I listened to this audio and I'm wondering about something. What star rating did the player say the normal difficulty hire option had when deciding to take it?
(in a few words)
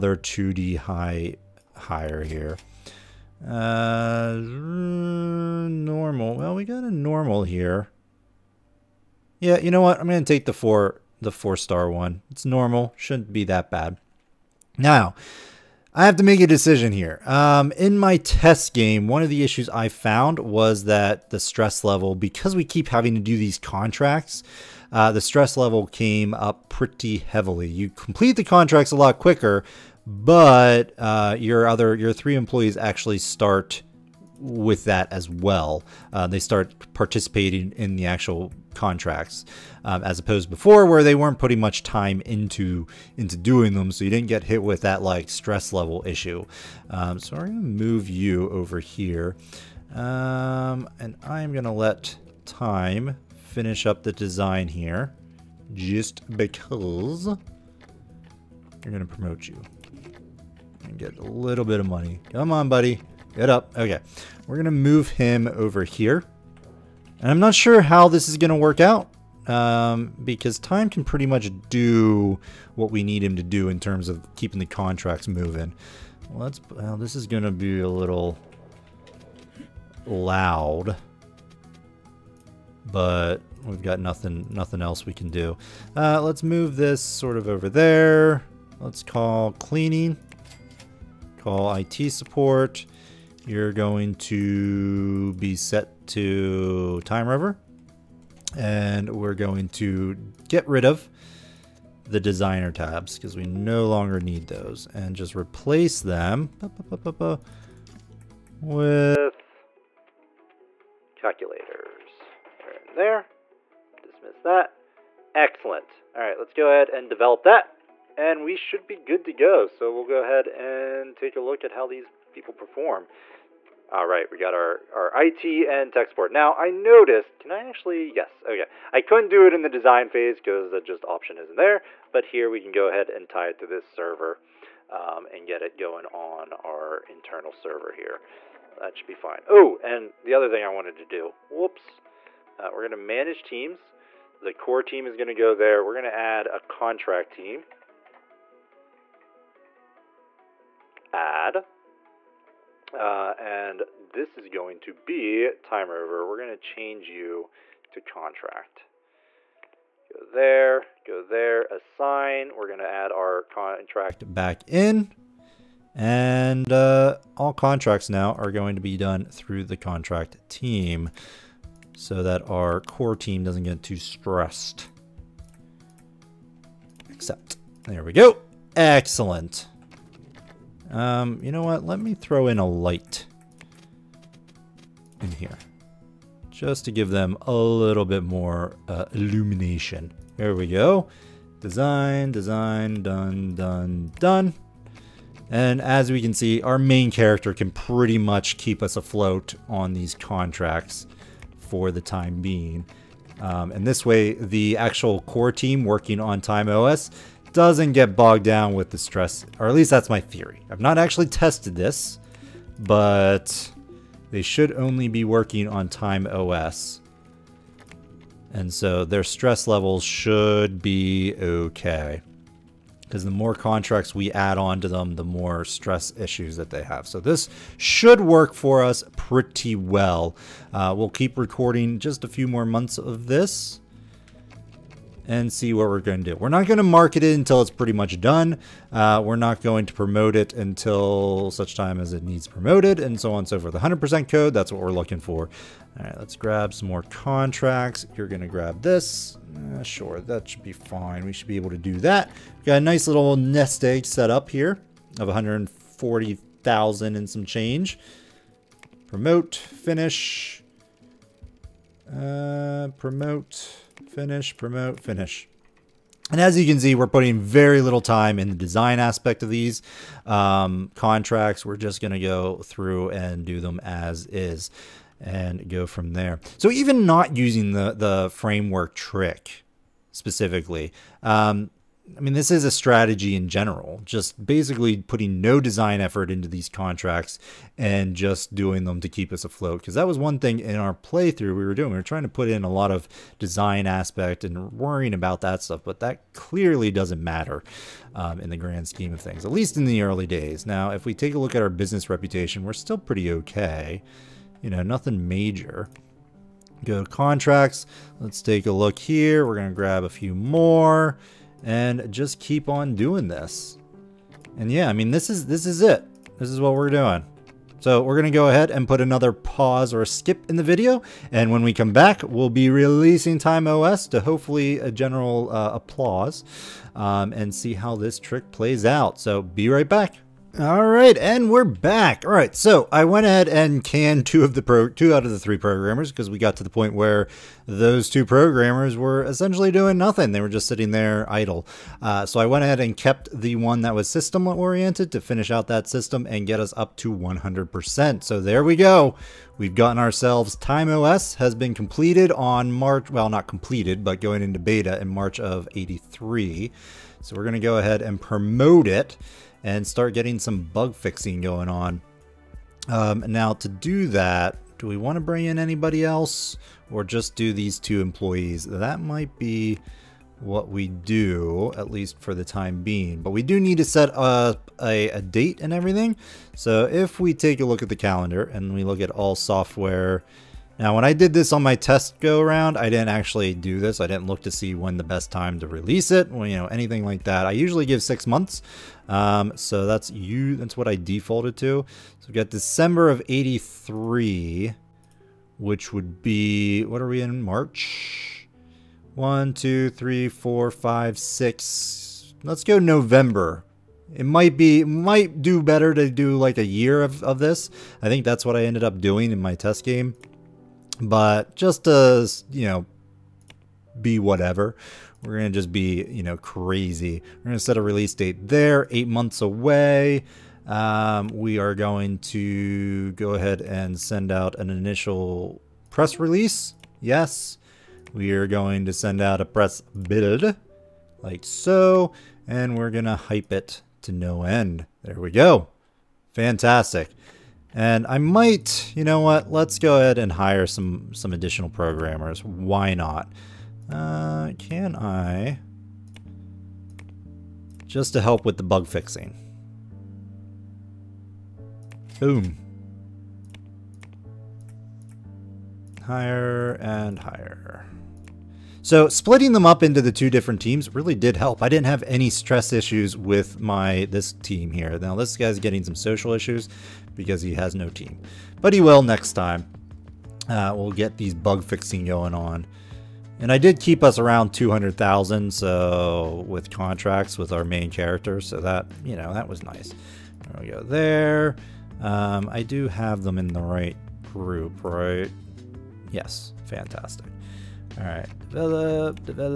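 4 star.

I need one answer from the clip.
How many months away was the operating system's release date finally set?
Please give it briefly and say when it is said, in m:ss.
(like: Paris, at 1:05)
8 months, at 6:58.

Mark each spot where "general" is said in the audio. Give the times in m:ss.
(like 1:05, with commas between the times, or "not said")
4:43, 5:24.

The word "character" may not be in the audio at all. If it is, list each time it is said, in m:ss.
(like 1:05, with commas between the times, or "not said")
3:17, 7:57.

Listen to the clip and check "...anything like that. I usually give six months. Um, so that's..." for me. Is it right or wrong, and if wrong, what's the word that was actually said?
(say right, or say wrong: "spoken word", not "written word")
right.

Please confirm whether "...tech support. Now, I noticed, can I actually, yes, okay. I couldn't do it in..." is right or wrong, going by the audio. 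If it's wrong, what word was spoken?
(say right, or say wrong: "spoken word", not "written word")
right.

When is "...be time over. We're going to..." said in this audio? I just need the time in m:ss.
2:34.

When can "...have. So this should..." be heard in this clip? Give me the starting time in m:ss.
3:46.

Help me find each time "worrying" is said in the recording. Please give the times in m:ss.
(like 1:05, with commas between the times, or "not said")
4:54.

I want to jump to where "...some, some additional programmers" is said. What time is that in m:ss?
7:20.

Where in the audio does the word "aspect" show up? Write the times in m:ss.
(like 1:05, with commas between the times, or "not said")
4:28, 4:53.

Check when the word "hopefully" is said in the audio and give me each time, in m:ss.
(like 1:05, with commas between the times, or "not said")
5:24.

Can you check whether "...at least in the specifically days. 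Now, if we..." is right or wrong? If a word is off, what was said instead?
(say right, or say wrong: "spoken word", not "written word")
wrong: "early", not "specifically".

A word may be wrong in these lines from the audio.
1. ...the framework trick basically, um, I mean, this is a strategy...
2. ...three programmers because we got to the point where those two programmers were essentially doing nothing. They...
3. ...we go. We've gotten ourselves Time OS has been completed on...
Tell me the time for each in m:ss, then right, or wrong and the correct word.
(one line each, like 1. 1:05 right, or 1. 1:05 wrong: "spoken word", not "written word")
1. 4:37 wrong: "specifically", not "basically"
2. 5:35 right
3. 5:48 right.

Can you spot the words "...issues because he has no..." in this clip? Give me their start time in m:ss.
7:46.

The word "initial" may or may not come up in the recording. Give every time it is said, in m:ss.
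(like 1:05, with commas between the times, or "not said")
7:04.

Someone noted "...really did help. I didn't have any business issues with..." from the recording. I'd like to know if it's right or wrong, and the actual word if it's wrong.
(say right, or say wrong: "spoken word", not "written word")
wrong: "stress", not "business".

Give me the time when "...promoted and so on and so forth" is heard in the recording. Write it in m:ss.
4:02.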